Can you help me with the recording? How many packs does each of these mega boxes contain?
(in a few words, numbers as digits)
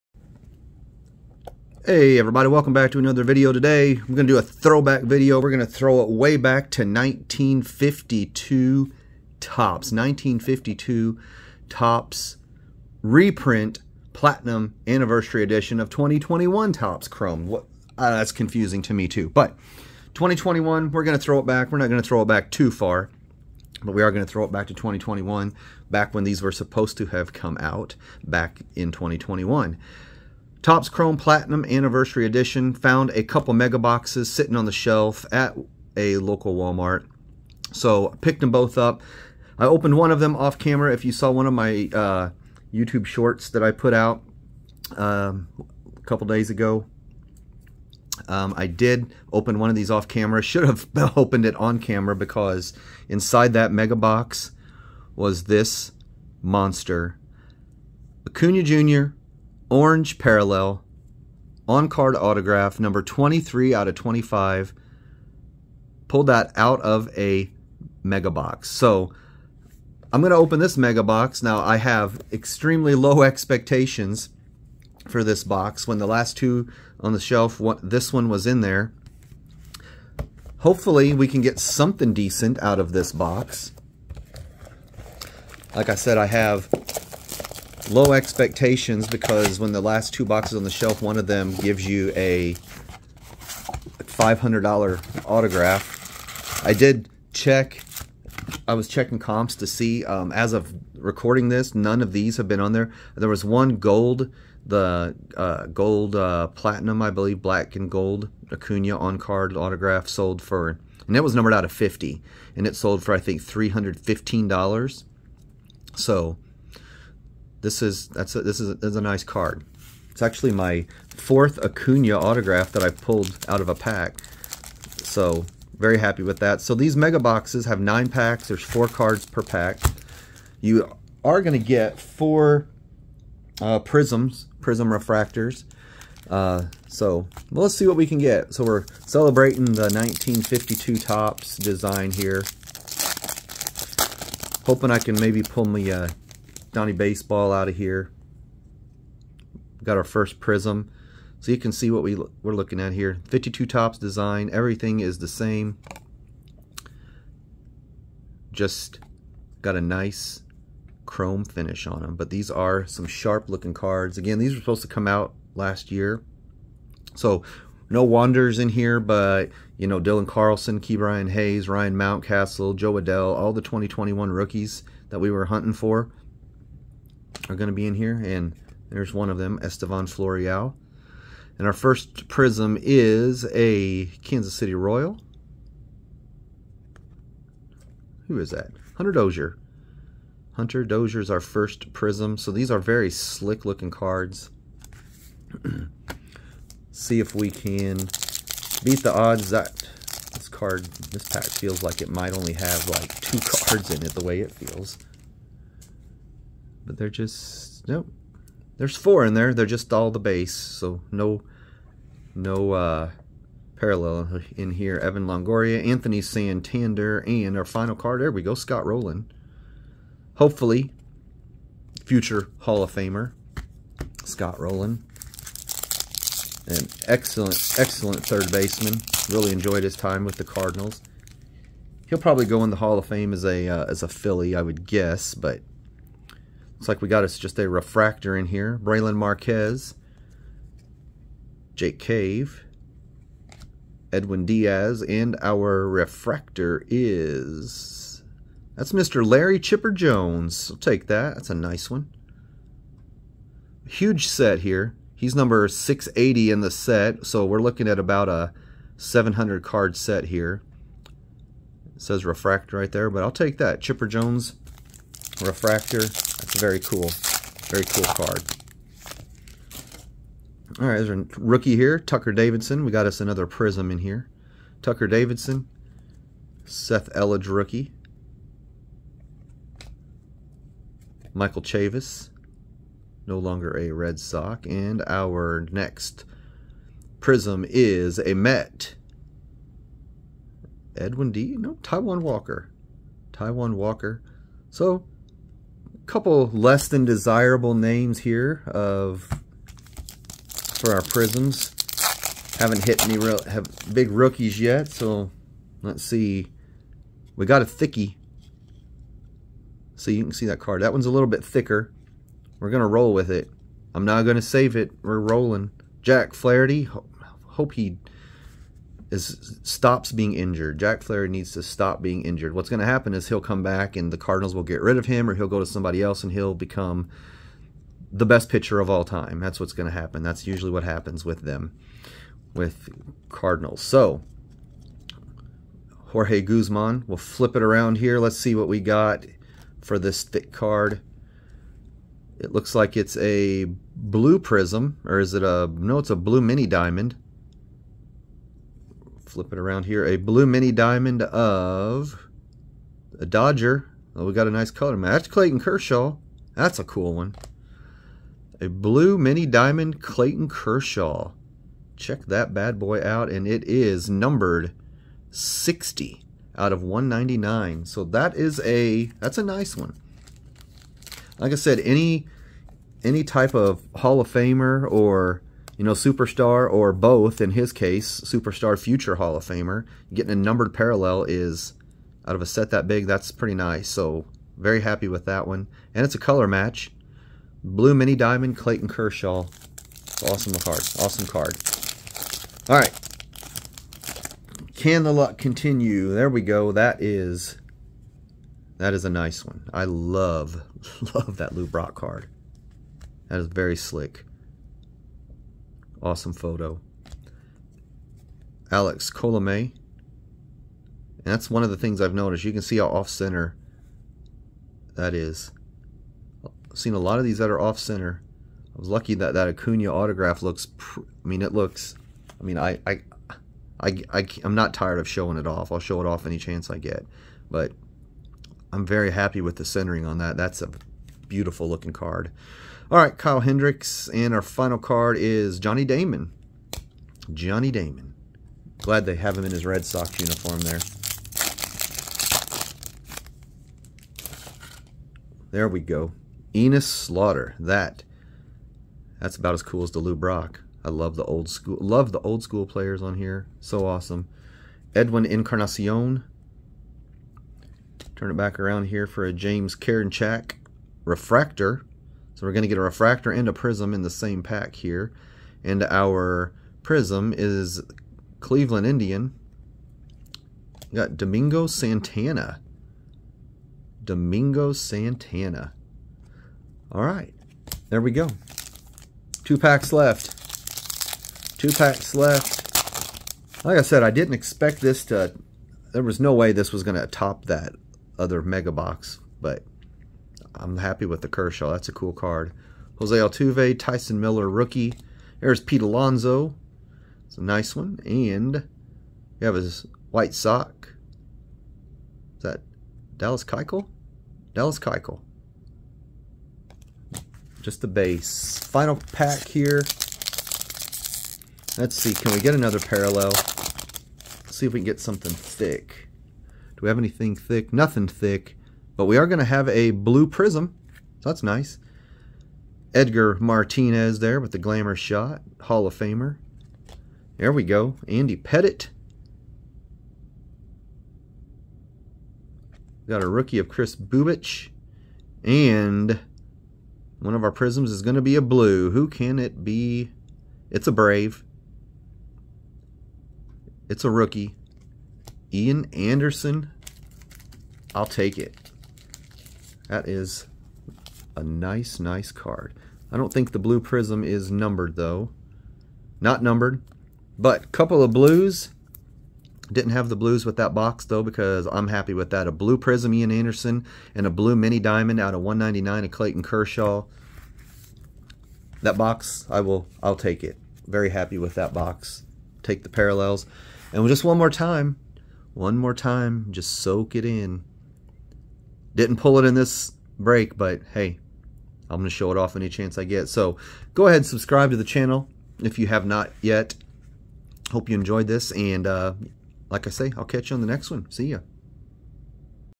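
9.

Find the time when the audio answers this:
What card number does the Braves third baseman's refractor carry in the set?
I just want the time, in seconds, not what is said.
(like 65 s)
255 s.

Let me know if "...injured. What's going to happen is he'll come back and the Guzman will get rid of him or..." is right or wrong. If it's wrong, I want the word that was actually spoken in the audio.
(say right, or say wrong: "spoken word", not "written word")
wrong: "Cardinals", not "Guzman".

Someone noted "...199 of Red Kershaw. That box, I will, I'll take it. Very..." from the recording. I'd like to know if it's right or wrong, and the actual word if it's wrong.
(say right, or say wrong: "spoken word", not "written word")
wrong: "Clayton", not "Red".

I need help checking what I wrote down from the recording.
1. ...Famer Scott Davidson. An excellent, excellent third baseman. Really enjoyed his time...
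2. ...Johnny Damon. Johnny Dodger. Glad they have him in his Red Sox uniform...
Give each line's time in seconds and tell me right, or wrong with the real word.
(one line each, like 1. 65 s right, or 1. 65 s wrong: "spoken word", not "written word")
1. 222 s wrong: "Rolen", not "Davidson"
2. 435 s wrong: "Damon", not "Dodger".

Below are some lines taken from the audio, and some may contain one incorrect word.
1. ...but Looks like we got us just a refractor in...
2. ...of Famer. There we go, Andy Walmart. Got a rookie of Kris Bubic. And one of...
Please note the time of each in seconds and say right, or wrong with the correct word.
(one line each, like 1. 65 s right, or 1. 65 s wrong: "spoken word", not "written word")
1. 235 s right
2. 525 s wrong: "Pettitte", not "Walmart".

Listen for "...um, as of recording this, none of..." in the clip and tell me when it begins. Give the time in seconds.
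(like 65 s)
100 s.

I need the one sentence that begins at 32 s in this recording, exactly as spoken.
Found a couple mega boxes sitting on the shelf at a local Walmart.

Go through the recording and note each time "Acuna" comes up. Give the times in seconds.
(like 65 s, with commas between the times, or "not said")
58 s, 108 s, 121 s, 419 s.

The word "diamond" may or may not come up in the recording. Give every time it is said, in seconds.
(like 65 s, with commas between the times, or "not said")
346 s, 350 s, 359 s, 388 s, 564 s.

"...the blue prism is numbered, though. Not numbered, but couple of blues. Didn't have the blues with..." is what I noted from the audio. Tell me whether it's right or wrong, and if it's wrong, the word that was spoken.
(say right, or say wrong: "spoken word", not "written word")
right.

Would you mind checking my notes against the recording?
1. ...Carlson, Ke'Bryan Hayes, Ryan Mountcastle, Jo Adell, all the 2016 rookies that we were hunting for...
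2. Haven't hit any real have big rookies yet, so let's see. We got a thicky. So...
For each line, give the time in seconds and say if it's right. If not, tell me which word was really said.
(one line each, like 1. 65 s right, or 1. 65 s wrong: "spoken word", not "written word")
1. 170 s wrong: "2021", not "2016"
2. 302 s right.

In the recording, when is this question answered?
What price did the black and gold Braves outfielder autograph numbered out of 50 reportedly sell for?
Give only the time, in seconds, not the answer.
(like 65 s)
113 s.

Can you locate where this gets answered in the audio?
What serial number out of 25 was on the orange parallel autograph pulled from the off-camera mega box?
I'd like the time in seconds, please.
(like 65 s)
62 s.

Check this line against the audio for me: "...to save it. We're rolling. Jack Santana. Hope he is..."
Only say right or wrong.
wrong.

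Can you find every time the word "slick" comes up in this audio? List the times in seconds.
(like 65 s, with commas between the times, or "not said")
193 s, 403 s.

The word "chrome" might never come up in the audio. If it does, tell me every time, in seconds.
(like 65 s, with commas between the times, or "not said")
17 s, 30 s, 161 s.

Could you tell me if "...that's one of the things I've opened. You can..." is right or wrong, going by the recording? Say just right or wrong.
wrong.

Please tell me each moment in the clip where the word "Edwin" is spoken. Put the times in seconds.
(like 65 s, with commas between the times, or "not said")
244 s, 290 s, 454 s.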